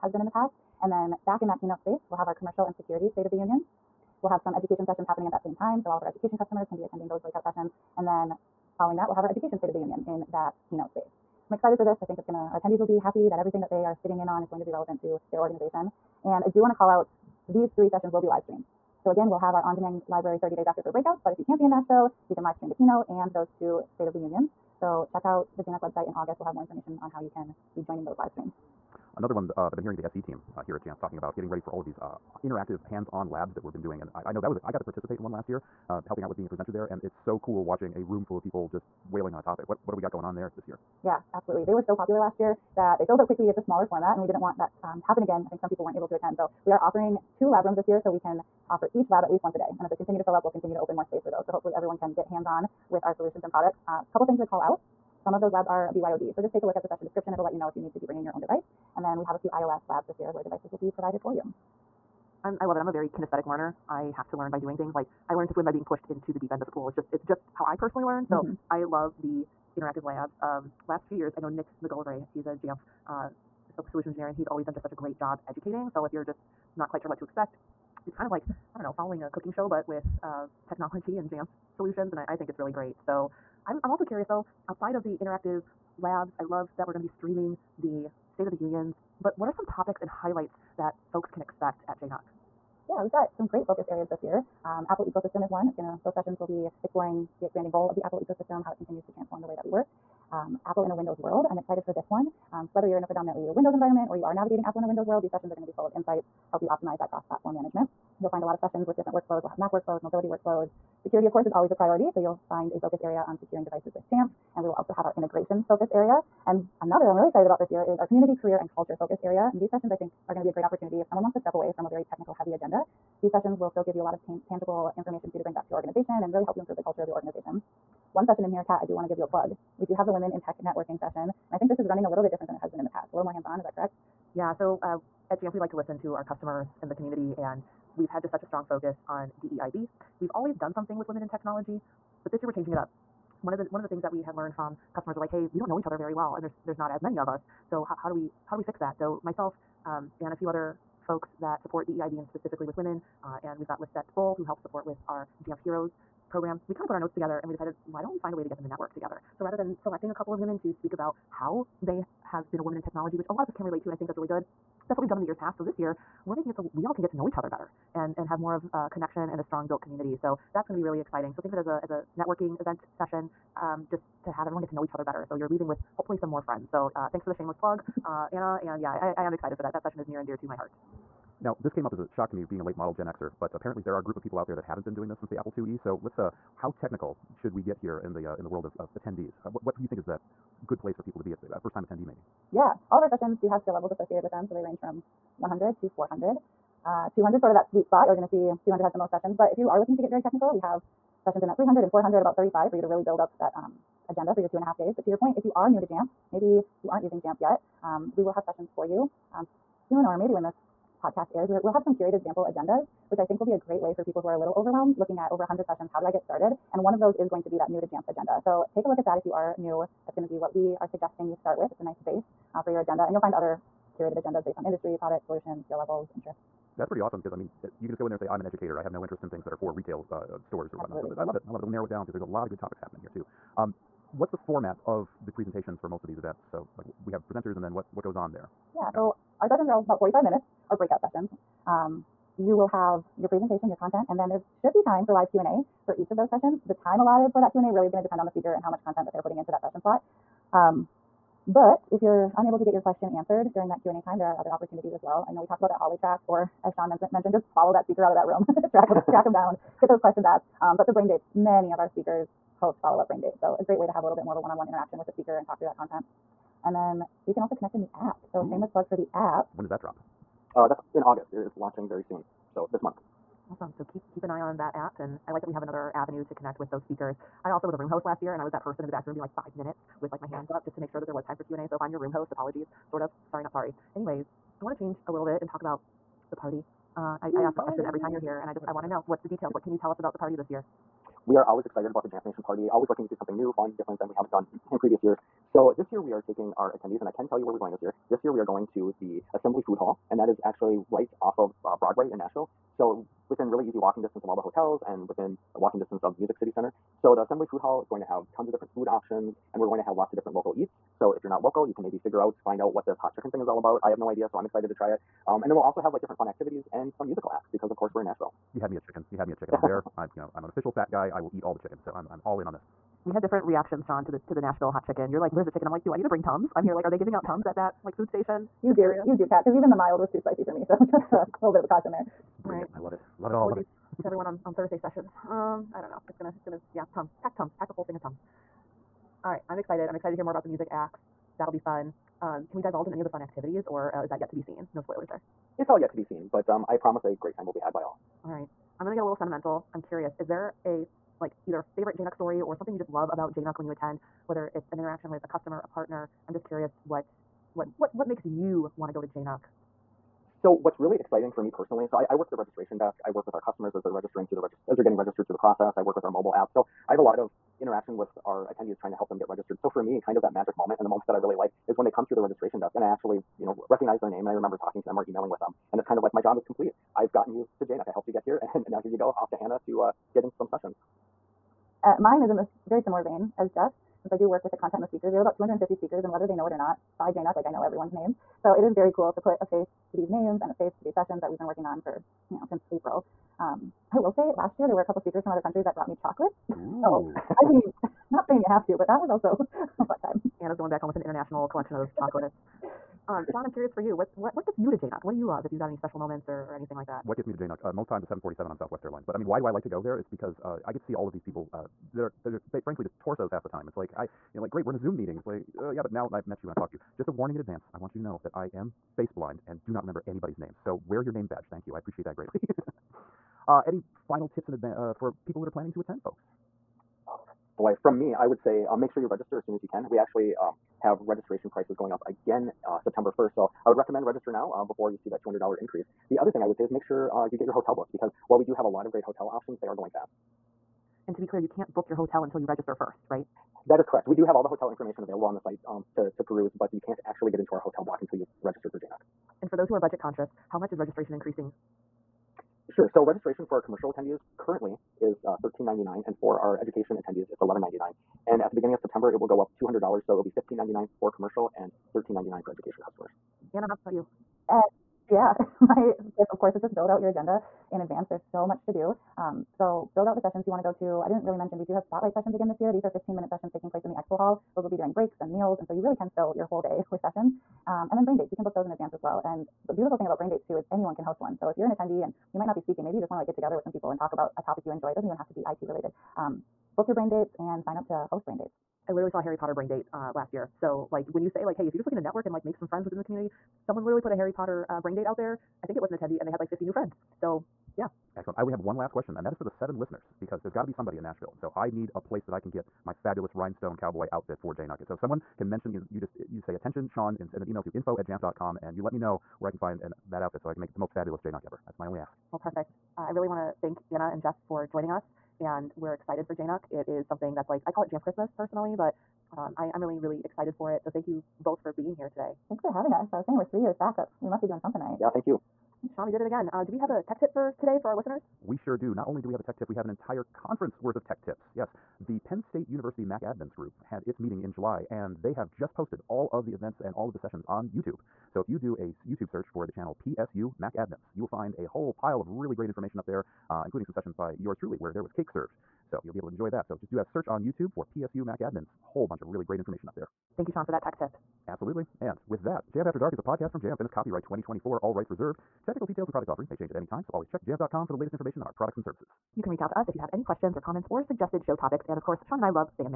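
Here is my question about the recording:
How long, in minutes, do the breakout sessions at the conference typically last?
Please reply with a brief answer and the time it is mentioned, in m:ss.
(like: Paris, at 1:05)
45, at 4:00.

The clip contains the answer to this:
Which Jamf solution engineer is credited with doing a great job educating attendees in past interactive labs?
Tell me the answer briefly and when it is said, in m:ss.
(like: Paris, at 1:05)
Nick McGillivray, at 1:11.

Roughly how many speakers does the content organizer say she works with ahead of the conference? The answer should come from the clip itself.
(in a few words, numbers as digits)
250.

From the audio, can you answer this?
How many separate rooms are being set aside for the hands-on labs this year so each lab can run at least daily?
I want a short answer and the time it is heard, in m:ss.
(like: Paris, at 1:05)
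2, at 0:47.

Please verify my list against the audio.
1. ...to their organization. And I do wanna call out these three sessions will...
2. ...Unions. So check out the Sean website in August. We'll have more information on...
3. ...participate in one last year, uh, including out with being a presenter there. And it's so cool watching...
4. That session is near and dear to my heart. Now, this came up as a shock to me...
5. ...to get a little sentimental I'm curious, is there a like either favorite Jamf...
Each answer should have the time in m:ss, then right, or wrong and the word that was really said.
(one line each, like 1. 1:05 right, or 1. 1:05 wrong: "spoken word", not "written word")
1. 0:15 right
2. 0:24 wrong: "JNUC", not "Sean"
3. 0:34 wrong: "helping", not "including"
4. 2:59 right
5. 5:48 wrong: "JNUC", not "Jamf".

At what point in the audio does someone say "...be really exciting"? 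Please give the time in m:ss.
2:50.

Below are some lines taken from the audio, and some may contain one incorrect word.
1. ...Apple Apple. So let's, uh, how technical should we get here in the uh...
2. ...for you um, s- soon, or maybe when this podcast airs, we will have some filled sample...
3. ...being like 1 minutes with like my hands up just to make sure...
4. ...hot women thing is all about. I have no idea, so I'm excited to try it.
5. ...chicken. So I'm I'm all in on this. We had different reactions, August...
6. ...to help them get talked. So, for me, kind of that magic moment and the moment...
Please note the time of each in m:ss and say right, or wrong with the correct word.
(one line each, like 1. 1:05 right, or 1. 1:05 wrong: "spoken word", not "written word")
1. 3:05 wrong: "IIe", not "Apple"
2. 3:28 wrong: "curated", not "filled"
3. 4:39 wrong: "5", not "1"
4. 5:12 wrong: "chicken", not "women"
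5. 5:21 wrong: "Sean", not "August"
6. 6:08 wrong: "registered", not "talked".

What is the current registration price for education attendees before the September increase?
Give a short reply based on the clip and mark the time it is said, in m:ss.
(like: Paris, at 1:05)
$1,199, at 7:37.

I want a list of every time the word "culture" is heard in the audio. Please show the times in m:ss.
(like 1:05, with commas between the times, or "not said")
1:58, 2:06.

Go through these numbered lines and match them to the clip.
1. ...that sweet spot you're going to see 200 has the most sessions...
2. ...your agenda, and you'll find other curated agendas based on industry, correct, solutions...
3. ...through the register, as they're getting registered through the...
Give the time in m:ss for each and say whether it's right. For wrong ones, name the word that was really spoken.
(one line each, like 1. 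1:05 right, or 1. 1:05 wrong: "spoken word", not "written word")
1. 3:17 right
2. 3:42 wrong: "product", not "correct"
3. 6:04 right.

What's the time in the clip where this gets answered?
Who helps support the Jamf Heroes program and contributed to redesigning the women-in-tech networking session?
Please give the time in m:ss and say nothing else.
2:33.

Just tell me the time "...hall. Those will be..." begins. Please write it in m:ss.
7:54.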